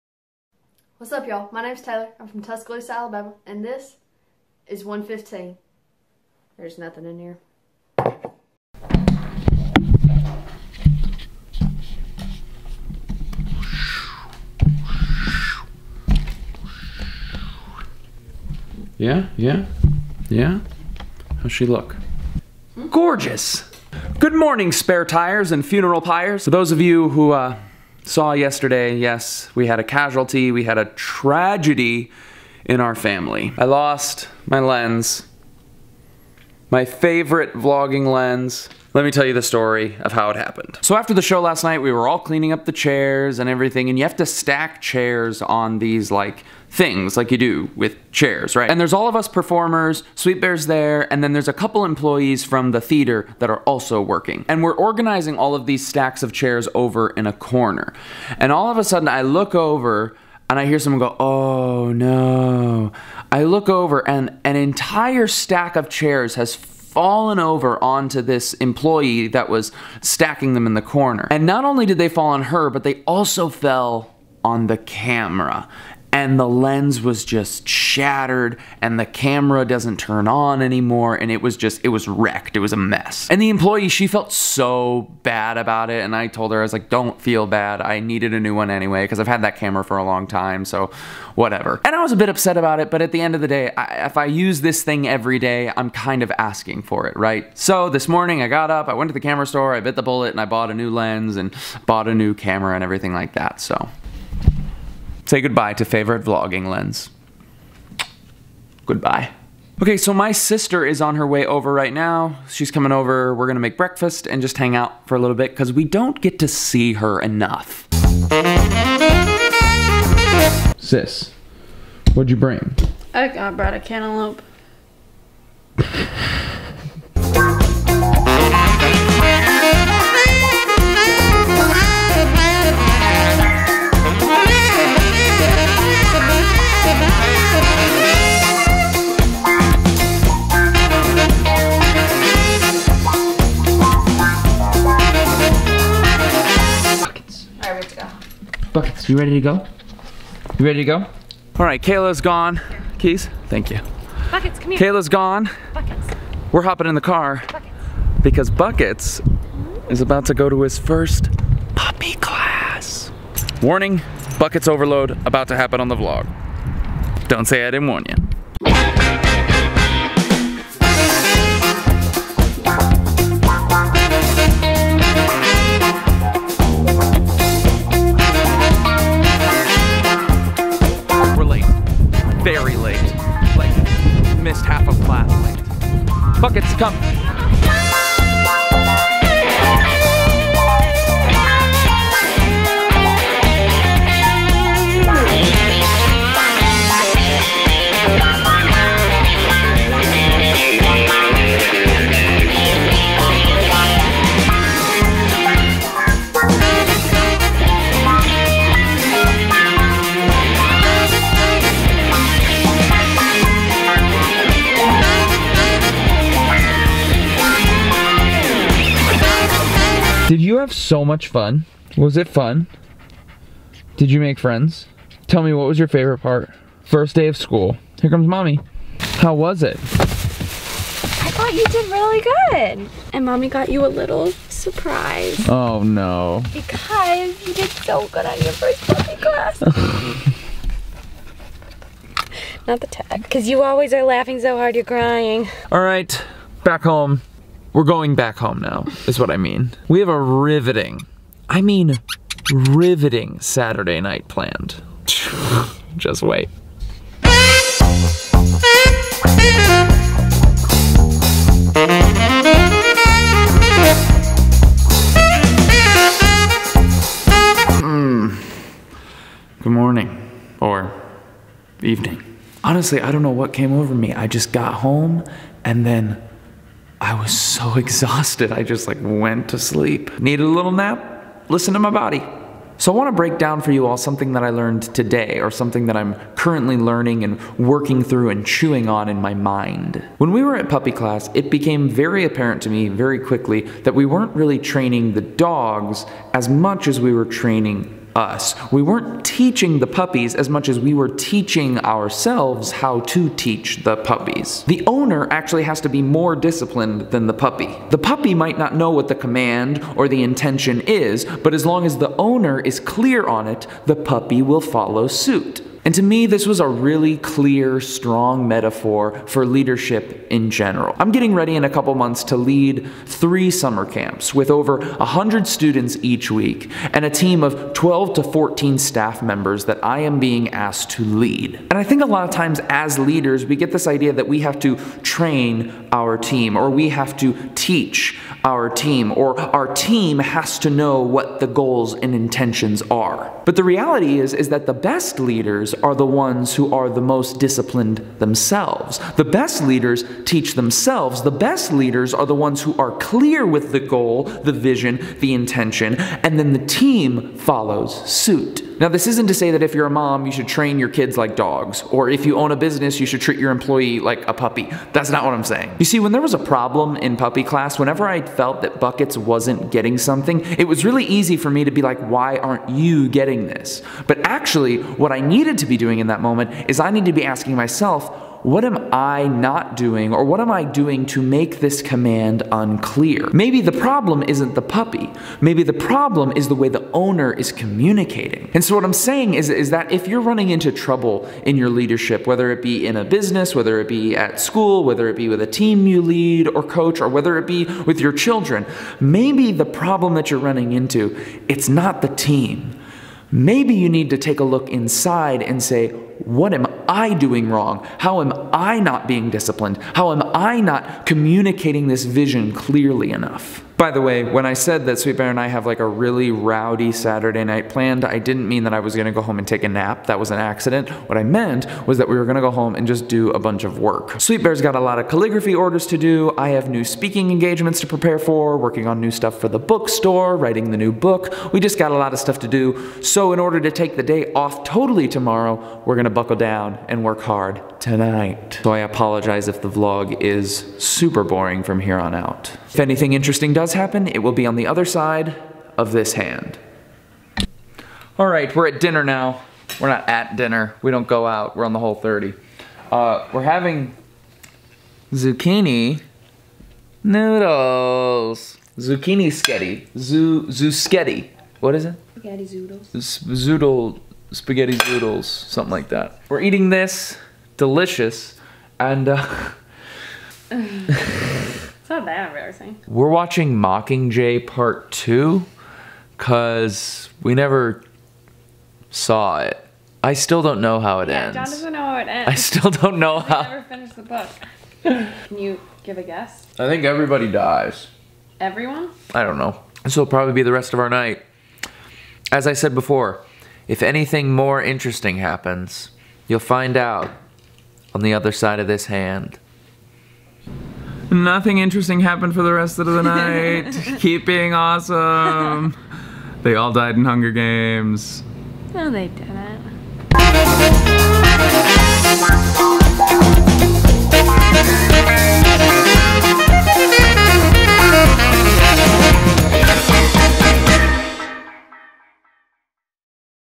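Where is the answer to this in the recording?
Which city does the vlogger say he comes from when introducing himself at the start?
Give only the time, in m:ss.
0:02.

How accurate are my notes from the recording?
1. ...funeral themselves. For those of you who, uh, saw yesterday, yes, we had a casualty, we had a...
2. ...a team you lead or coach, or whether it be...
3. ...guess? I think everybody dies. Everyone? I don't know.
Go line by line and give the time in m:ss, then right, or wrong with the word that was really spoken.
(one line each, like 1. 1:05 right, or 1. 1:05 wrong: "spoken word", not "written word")
1. 0:25 wrong: "pyres", not "themselves"
2. 6:35 right
3. 8:06 right.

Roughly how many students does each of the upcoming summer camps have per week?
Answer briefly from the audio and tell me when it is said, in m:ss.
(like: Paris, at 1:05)
Over 100, at 5:24.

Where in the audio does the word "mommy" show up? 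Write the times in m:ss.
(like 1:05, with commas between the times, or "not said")
3:48, 3:53.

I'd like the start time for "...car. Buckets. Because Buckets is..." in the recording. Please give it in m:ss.
2:37.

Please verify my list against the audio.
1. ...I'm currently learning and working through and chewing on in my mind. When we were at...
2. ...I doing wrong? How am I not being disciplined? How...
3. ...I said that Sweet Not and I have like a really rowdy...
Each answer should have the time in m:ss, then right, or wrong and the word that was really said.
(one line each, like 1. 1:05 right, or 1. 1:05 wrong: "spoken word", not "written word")
1. 4:45 right
2. 6:46 right
3. 6:54 wrong: "Bear", not "Not".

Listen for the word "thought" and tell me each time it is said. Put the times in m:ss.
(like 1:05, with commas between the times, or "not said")
3:51.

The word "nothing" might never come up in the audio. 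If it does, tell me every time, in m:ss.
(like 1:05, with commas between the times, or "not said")
0:06, 8:21.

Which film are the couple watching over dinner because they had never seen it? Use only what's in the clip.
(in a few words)
Mockingjay Part 2.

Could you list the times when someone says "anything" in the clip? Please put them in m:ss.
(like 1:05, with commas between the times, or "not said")
7:22, 8:13.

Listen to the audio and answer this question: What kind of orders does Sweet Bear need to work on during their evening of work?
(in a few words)
Calligraphy orders.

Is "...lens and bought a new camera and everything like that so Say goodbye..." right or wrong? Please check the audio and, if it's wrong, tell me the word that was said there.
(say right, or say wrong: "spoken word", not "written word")
right.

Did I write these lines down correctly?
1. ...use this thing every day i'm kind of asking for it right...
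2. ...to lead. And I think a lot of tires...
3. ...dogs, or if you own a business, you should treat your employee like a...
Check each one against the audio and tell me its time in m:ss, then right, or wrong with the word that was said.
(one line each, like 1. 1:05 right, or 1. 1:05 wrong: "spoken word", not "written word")
1. 1:34 right
2. 5:30 wrong: "times", not "tires"
3. 6:01 right.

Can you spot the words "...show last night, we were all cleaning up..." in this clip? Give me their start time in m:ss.
0:41.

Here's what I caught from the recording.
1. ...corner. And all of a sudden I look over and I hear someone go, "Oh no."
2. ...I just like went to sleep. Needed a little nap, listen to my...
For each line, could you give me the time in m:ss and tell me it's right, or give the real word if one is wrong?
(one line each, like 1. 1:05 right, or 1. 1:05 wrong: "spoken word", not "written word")
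1. 0:57 right
2. 4:38 right.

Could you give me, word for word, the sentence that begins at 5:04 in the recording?
The owner actually has to be more disciplined than the puppy.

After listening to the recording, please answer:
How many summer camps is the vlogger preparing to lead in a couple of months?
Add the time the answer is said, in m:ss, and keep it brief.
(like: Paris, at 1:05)
3, at 5:23.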